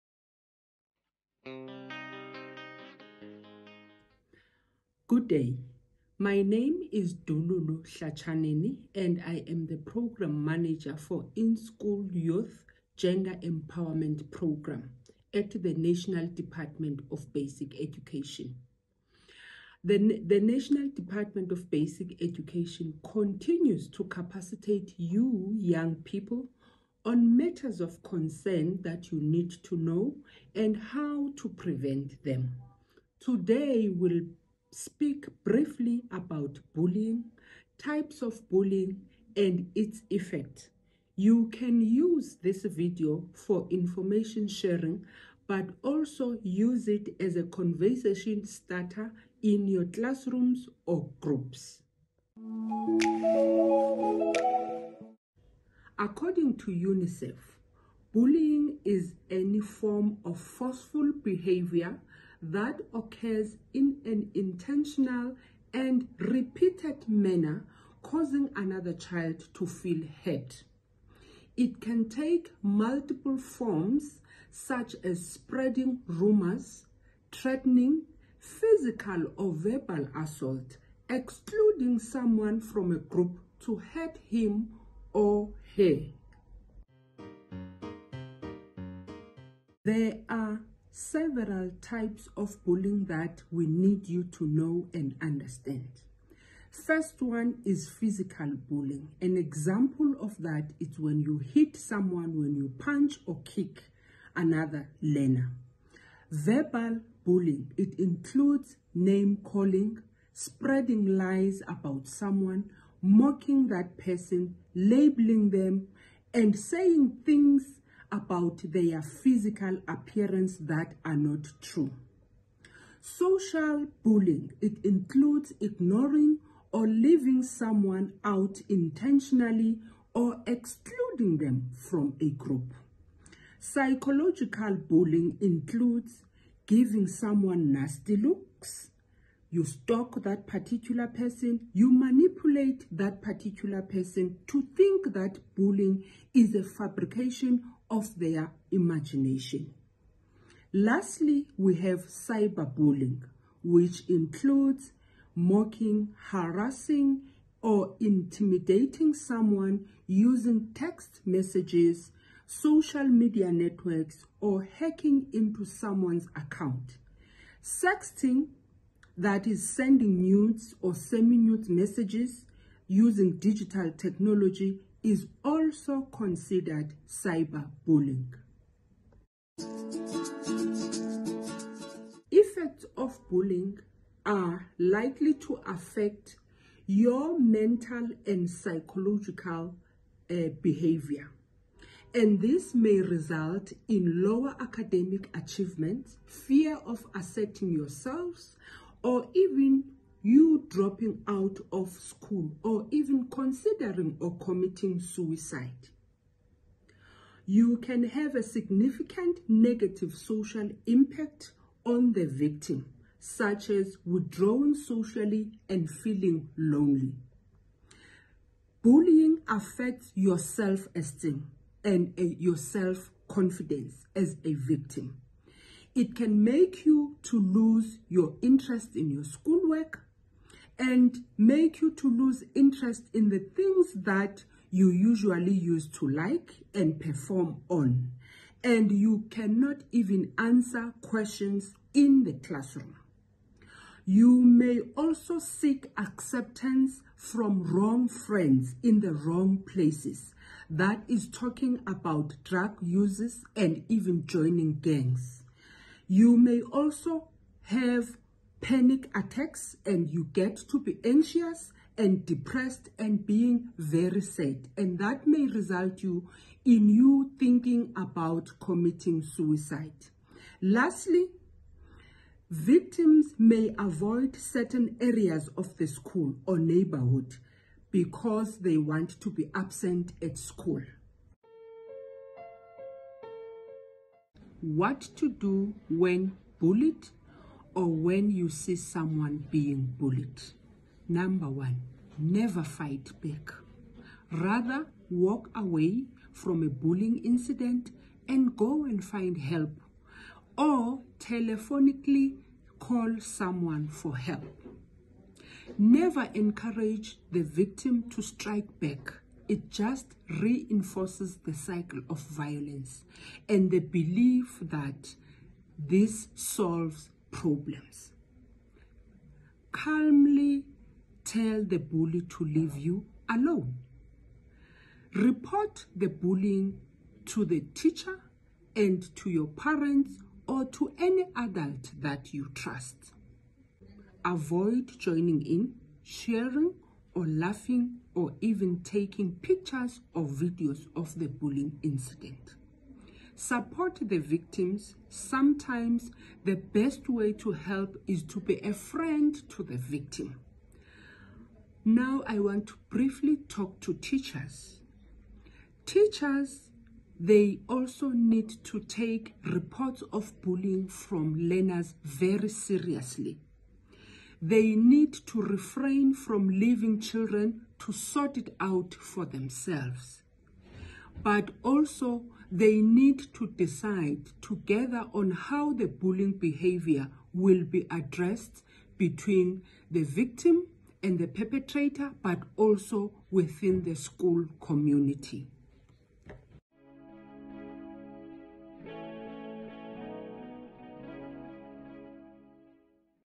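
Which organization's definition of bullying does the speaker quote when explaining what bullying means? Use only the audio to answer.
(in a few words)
UNICEF.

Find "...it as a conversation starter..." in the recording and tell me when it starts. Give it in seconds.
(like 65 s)
46 s.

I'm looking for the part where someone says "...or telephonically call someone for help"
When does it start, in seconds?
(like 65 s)
300 s.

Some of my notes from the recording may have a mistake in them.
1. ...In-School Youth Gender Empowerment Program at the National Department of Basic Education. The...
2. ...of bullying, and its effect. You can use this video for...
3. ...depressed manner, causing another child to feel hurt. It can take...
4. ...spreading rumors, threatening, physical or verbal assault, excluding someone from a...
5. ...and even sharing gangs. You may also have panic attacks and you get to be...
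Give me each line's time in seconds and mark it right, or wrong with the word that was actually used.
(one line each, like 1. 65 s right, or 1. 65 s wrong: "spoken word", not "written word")
1. 11 s right
2. 38 s right
3. 66 s wrong: "repeated", not "depressed"
4. 75 s right
5. 253 s wrong: "joining", not "sharing".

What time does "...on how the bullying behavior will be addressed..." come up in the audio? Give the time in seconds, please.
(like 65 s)
375 s.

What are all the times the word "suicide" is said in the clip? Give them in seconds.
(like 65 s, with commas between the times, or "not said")
204 s, 269 s.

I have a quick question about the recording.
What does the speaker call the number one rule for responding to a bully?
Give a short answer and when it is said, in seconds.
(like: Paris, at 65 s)
Never fight back, at 292 s.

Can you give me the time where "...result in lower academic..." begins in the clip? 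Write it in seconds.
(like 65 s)
192 s.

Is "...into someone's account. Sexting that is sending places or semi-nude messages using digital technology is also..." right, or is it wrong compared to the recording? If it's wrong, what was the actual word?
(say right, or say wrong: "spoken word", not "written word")
wrong: "nudes", not "places".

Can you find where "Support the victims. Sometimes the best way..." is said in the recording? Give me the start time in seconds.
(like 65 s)
343 s.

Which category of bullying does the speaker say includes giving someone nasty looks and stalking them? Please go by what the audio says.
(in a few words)
Psychological bullying.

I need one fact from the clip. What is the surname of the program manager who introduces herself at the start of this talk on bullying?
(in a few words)
Hlatsheneni.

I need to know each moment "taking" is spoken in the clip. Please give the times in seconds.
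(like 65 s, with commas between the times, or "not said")
338 s.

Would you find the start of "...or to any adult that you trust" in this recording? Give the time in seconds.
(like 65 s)
330 s.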